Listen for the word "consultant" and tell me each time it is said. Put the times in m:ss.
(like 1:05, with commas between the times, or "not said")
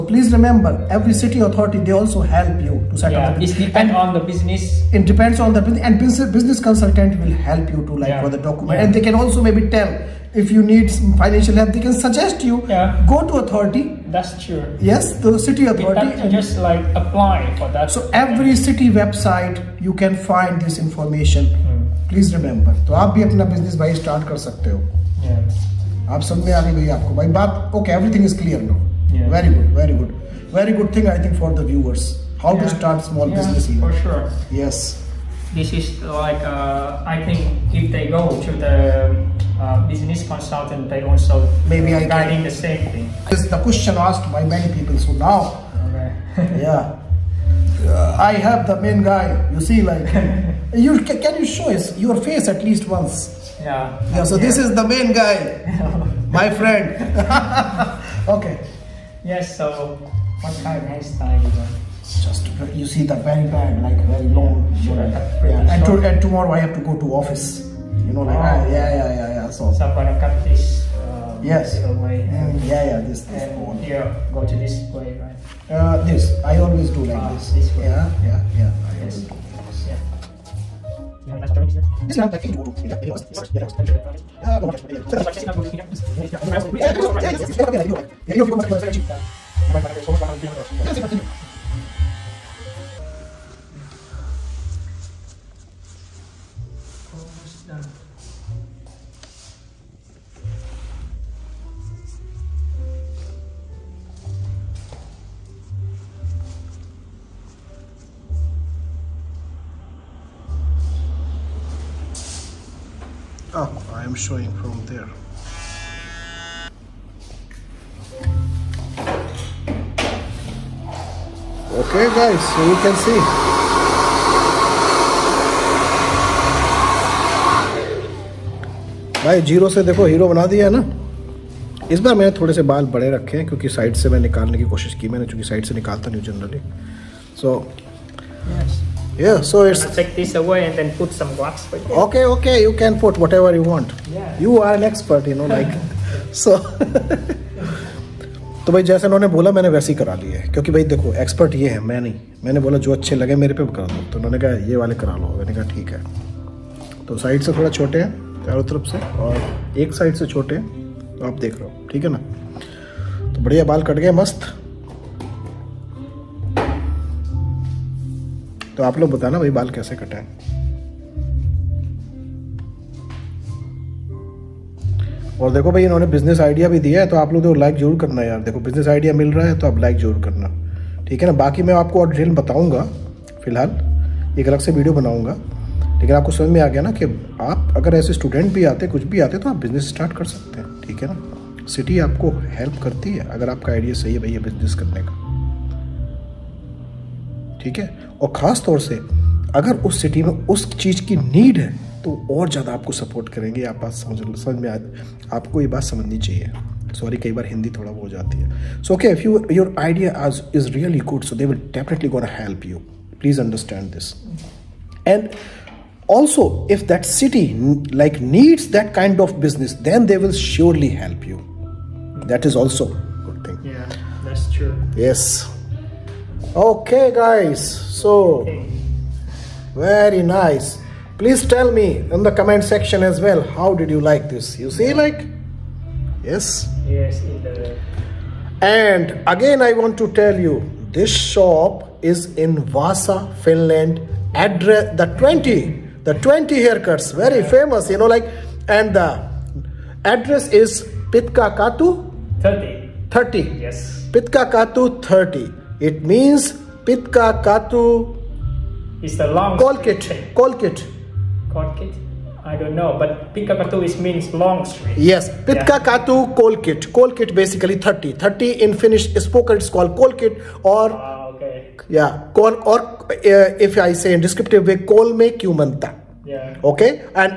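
0:06, 0:40.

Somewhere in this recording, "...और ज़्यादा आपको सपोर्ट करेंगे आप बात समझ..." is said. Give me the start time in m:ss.
3:22.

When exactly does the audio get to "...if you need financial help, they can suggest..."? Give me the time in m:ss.
0:10.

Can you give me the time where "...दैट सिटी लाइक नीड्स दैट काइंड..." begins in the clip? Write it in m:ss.
3:36.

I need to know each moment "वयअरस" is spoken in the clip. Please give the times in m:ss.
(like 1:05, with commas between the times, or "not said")
0:31.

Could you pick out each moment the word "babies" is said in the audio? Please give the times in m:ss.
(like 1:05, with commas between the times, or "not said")
not said.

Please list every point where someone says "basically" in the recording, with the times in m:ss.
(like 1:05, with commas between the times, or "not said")
4:27.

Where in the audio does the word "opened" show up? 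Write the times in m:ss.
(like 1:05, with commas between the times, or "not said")
not said.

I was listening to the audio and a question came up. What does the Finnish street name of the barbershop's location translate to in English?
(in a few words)
Long street.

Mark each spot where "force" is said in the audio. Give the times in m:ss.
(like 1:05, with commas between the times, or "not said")
not said.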